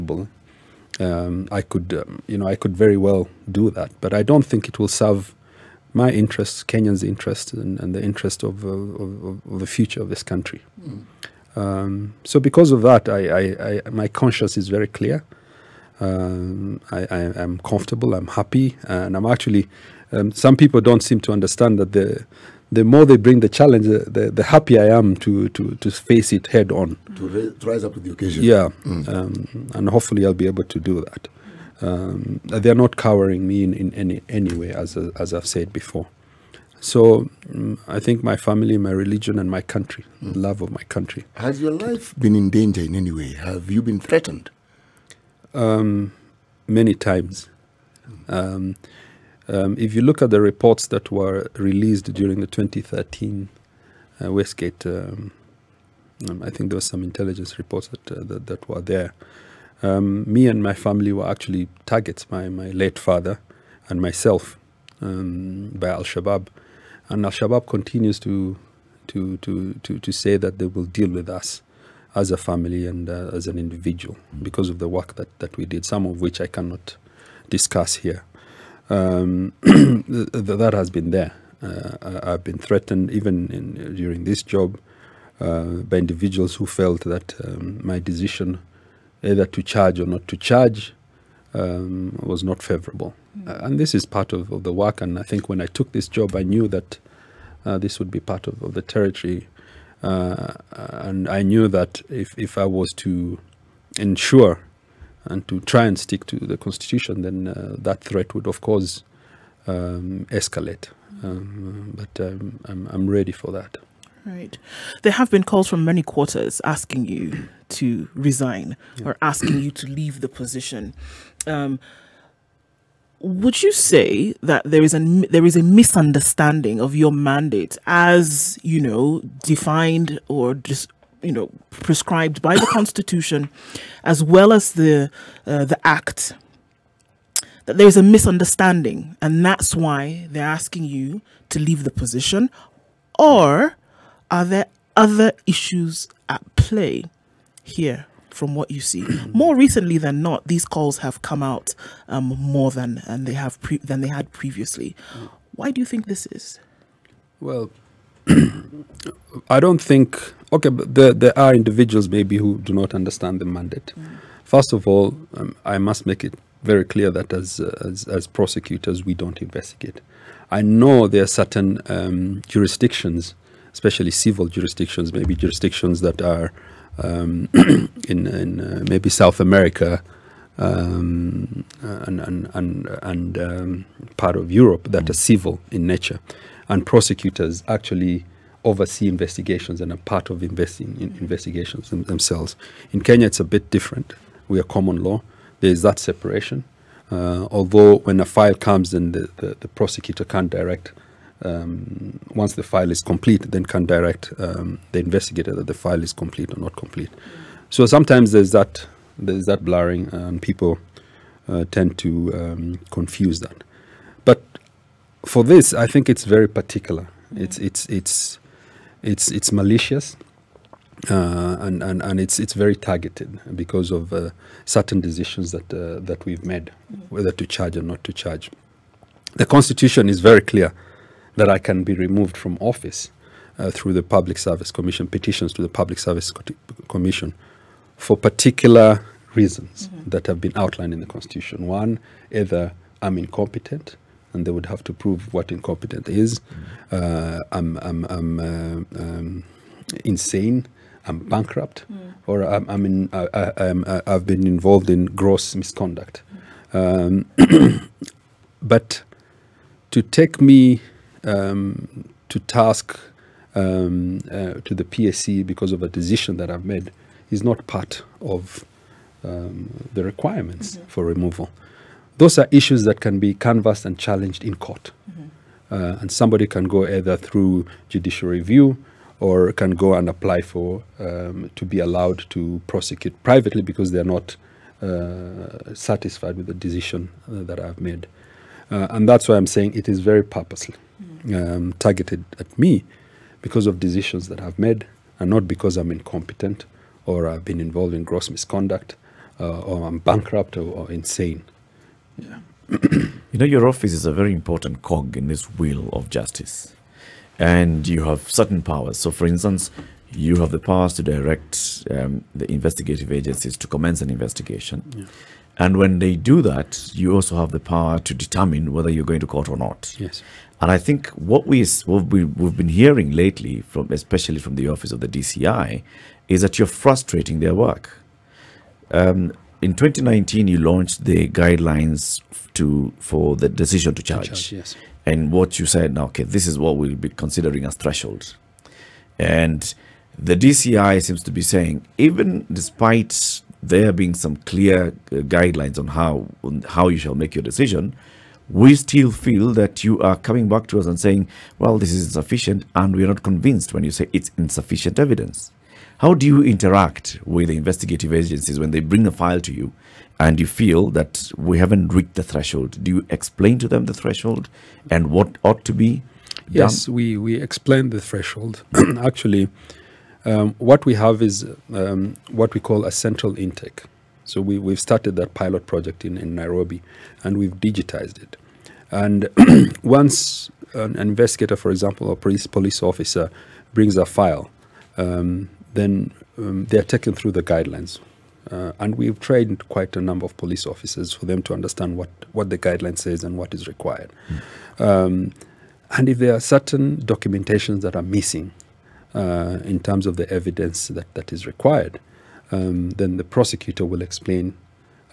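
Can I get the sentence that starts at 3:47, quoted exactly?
whether to charge or not to charge.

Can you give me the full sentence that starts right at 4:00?
that have been outlined in the Constitution.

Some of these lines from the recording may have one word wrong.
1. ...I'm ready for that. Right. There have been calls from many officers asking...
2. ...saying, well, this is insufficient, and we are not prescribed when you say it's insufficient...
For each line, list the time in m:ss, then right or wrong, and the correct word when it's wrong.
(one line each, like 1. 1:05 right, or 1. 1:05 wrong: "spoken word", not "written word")
1. 1:52 wrong: "quarters", not "officers"
2. 5:50 wrong: "convinced", not "prescribed".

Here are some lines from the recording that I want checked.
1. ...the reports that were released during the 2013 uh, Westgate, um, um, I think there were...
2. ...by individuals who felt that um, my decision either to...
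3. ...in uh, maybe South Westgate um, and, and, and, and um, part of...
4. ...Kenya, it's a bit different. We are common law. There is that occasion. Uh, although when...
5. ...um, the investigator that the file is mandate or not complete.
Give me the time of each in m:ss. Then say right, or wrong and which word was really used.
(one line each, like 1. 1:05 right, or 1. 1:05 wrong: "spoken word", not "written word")
1. 0:50 right
2. 1:25 right
3. 2:58 wrong: "America", not "Westgate"
4. 3:13 wrong: "separation", not "occasion"
5. 3:24 wrong: "complete", not "mandate".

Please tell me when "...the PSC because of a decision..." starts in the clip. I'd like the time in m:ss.
4:24.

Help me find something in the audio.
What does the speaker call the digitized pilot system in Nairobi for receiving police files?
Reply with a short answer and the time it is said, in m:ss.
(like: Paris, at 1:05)
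central intake, at 6:12.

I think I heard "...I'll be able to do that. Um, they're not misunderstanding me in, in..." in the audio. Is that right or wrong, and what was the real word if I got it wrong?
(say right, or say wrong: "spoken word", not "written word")
wrong: "cowering", not "misunderstanding".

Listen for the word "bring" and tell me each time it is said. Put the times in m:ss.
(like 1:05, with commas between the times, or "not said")
0:23, 5:58, 6:23.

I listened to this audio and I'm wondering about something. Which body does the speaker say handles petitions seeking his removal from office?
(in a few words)
Public Service Commission.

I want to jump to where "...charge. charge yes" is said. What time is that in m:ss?
5:34.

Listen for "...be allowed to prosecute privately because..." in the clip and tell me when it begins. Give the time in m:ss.
4:41.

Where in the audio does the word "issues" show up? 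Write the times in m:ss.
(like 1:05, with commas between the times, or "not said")
2:25, 4:32.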